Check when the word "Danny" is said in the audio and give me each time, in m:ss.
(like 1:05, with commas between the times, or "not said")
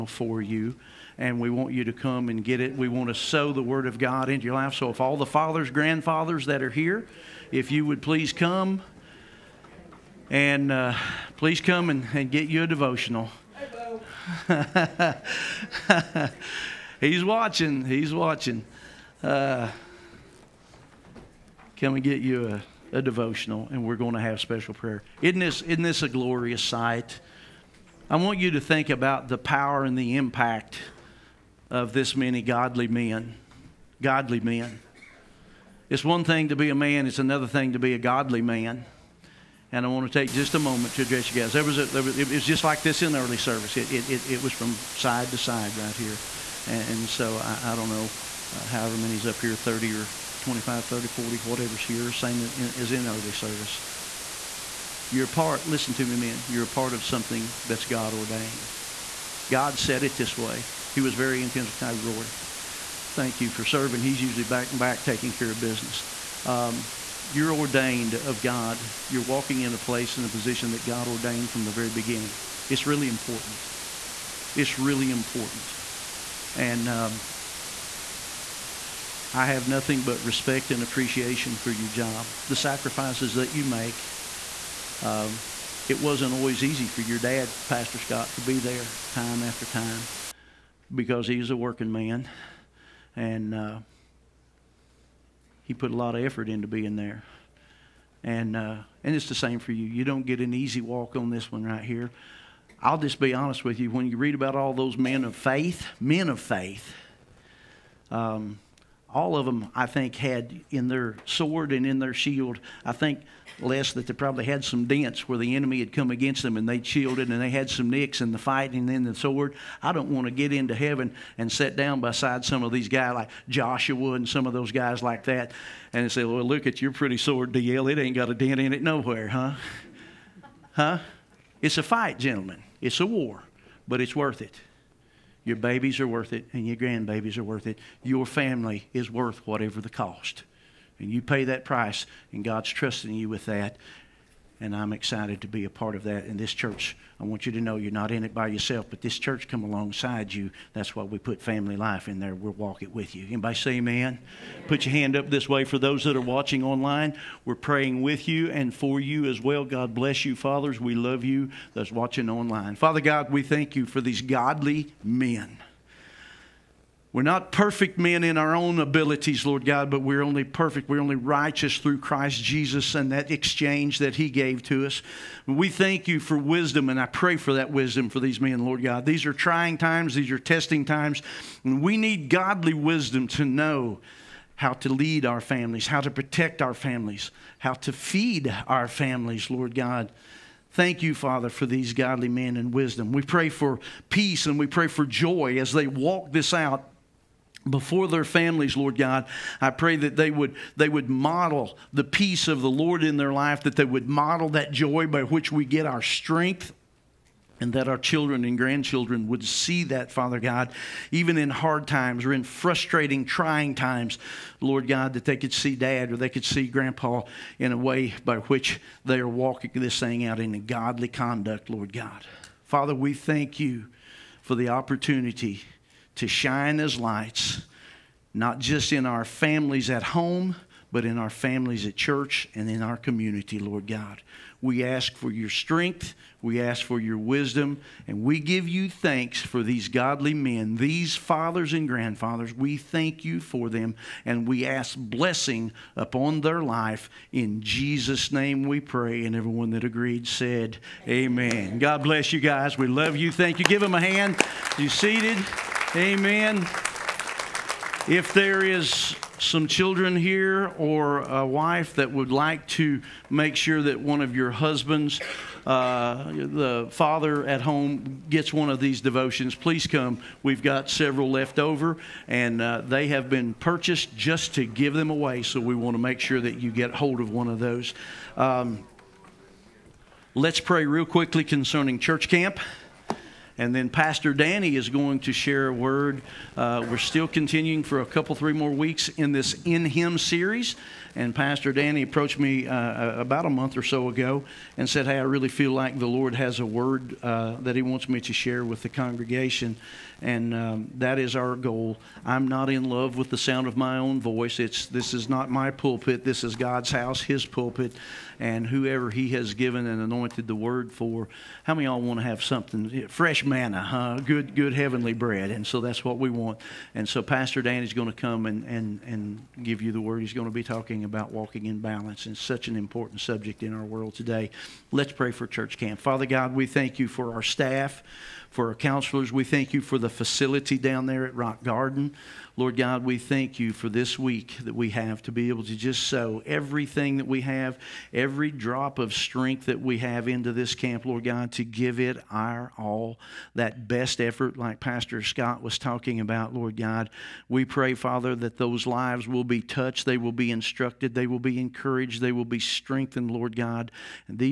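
4:44, 4:51, 5:17.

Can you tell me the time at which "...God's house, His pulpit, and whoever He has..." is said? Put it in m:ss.
5:06.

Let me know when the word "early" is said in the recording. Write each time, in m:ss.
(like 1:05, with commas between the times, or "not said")
0:43, 0:53.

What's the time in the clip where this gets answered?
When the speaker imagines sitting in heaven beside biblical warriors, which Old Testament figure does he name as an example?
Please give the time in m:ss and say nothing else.
2:03.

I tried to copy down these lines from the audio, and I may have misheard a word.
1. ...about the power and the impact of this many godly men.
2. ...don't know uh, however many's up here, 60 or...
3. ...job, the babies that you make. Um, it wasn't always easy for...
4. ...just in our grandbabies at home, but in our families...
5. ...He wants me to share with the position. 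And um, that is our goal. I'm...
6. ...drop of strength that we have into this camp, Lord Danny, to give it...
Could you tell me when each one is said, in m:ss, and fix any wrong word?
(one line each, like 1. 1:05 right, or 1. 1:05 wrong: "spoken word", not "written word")
1. 0:28 right
2. 0:47 wrong: "30", not "60"
3. 1:21 wrong: "sacrifices", not "babies"
4. 3:48 wrong: "families", not "grandbabies"
5. 4:57 wrong: "congregation", not "position"
6. 5:38 wrong: "God", not "Danny".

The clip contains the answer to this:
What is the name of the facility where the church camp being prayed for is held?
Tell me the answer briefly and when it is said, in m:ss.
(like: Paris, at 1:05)
Rock Garden, at 5:31.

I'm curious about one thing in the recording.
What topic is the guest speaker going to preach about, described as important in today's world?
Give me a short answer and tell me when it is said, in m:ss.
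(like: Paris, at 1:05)
walking in balance, at 5:21.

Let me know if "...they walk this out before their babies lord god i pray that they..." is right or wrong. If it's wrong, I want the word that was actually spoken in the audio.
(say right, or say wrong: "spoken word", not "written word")
wrong: "families", not "babies".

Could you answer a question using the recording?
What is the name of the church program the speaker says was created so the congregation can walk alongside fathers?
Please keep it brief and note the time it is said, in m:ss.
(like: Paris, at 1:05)
family life, at 2:31.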